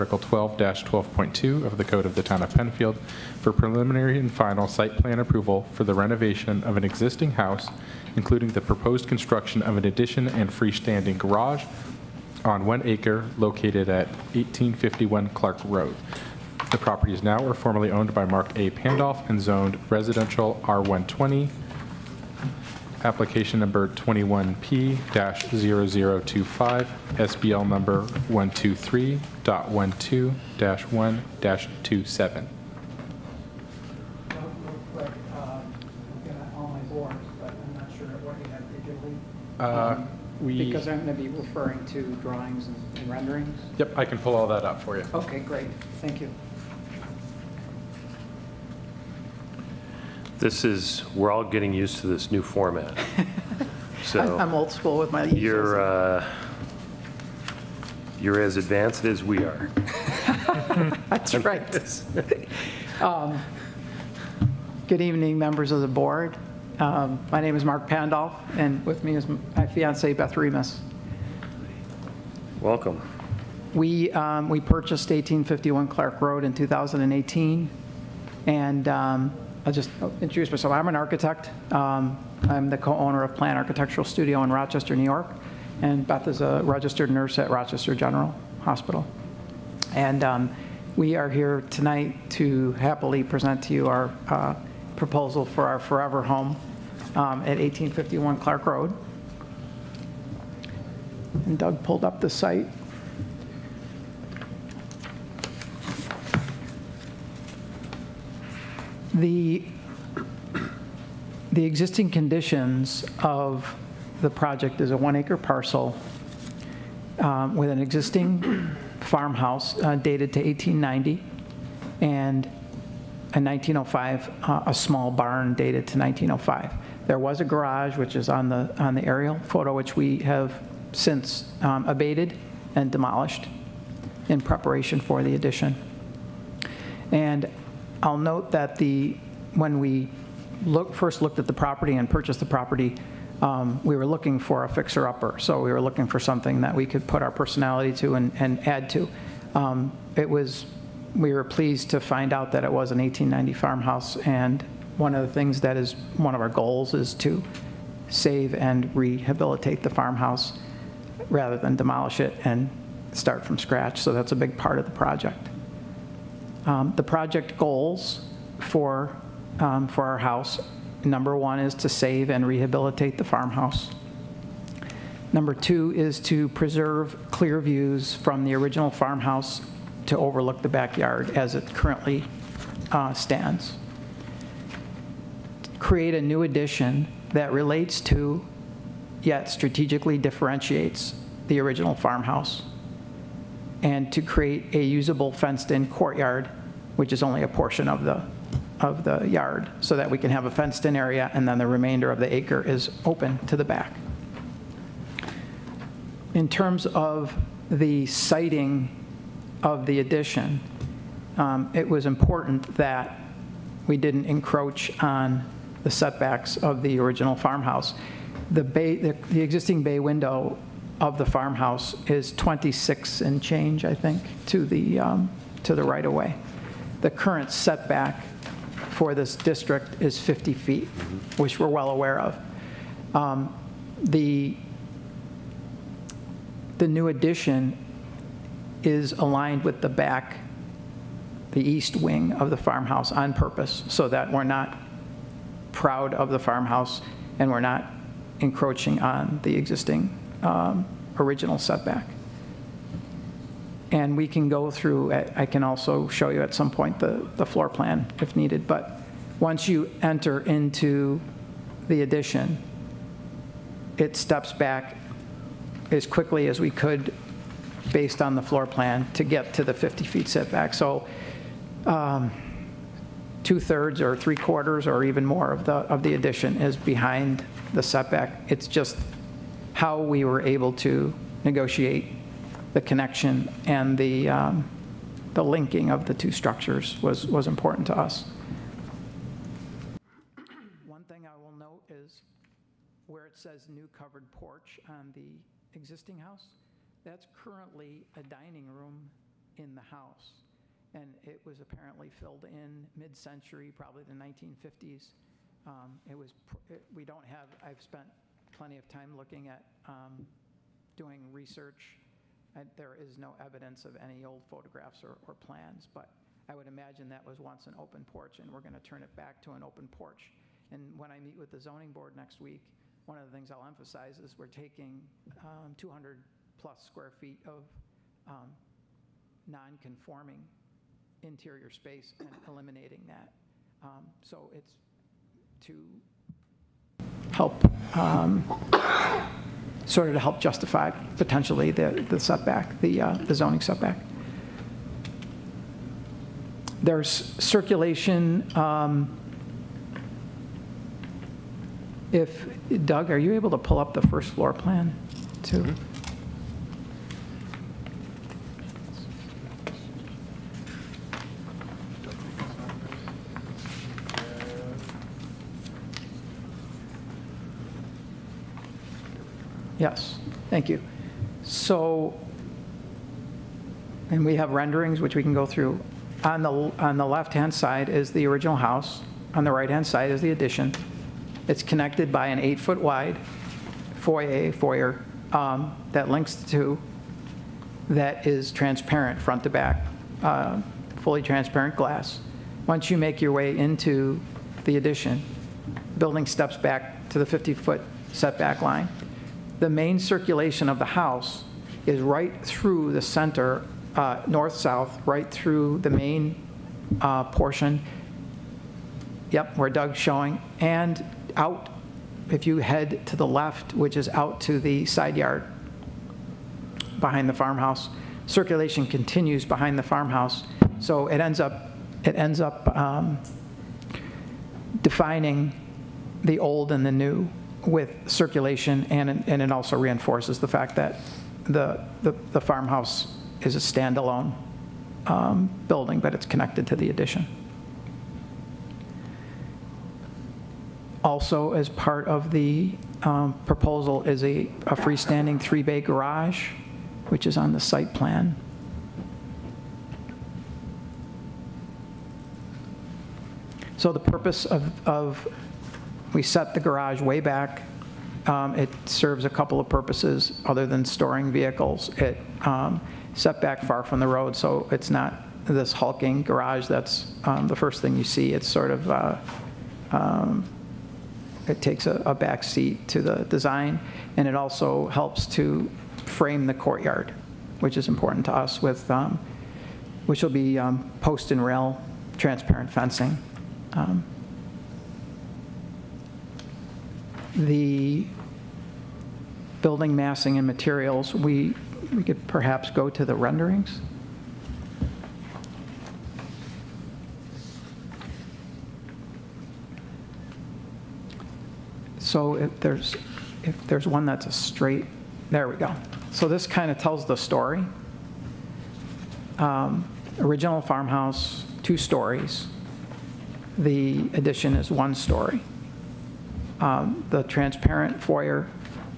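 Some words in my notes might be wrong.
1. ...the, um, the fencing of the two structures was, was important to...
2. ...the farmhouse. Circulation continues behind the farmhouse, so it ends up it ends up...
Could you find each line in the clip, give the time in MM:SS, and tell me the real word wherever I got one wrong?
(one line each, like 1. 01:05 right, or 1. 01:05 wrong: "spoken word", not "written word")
1. 04:43 wrong: "linking", not "fencing"
2. 06:57 right.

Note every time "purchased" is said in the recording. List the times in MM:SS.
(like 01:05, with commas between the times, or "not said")
01:14, 02:22.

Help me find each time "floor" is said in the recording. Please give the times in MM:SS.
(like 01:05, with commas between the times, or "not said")
04:17, 04:28, 05:54.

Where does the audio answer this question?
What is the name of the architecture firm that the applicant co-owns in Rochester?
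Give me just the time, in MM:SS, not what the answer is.
01:23.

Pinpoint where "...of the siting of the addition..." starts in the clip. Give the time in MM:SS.
03:26.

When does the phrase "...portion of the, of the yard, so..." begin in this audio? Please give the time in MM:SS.
03:17.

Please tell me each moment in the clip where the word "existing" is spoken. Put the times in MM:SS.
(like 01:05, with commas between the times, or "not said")
00:06, 01:51, 01:57, 03:39, 04:09, 04:55.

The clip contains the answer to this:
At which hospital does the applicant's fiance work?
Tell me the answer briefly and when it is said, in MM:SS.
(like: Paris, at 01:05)
Rochester General Hospital, at 01:27.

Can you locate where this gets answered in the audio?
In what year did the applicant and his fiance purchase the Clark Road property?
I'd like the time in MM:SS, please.
01:16.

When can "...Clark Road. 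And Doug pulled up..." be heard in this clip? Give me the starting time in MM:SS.
01:38.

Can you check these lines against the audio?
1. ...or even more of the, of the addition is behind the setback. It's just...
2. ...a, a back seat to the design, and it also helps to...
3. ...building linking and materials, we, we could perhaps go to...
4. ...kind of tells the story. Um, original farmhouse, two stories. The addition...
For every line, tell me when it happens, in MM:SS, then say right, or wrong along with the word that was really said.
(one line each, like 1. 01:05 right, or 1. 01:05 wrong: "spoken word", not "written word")
1. 04:34 right
2. 07:51 right
3. 08:09 wrong: "massing", not "linking"
4. 08:26 right.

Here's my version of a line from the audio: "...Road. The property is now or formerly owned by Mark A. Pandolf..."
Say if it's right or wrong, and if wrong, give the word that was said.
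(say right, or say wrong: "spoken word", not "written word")
right.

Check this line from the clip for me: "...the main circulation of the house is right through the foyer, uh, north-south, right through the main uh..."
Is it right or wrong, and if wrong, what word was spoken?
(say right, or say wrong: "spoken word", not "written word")
wrong: "center", not "foyer".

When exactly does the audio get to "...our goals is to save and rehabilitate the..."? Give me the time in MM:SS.
02:36.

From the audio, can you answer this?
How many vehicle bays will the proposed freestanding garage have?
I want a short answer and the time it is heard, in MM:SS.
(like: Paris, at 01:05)
3, at 07:25.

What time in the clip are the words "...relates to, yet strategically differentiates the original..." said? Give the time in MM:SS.
03:07.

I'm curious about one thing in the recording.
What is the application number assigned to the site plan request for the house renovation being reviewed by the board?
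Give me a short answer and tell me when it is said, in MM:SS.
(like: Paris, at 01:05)
21P-0025, at 00:23.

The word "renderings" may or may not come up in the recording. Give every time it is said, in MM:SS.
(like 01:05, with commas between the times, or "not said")
00:43, 06:14, 08:13.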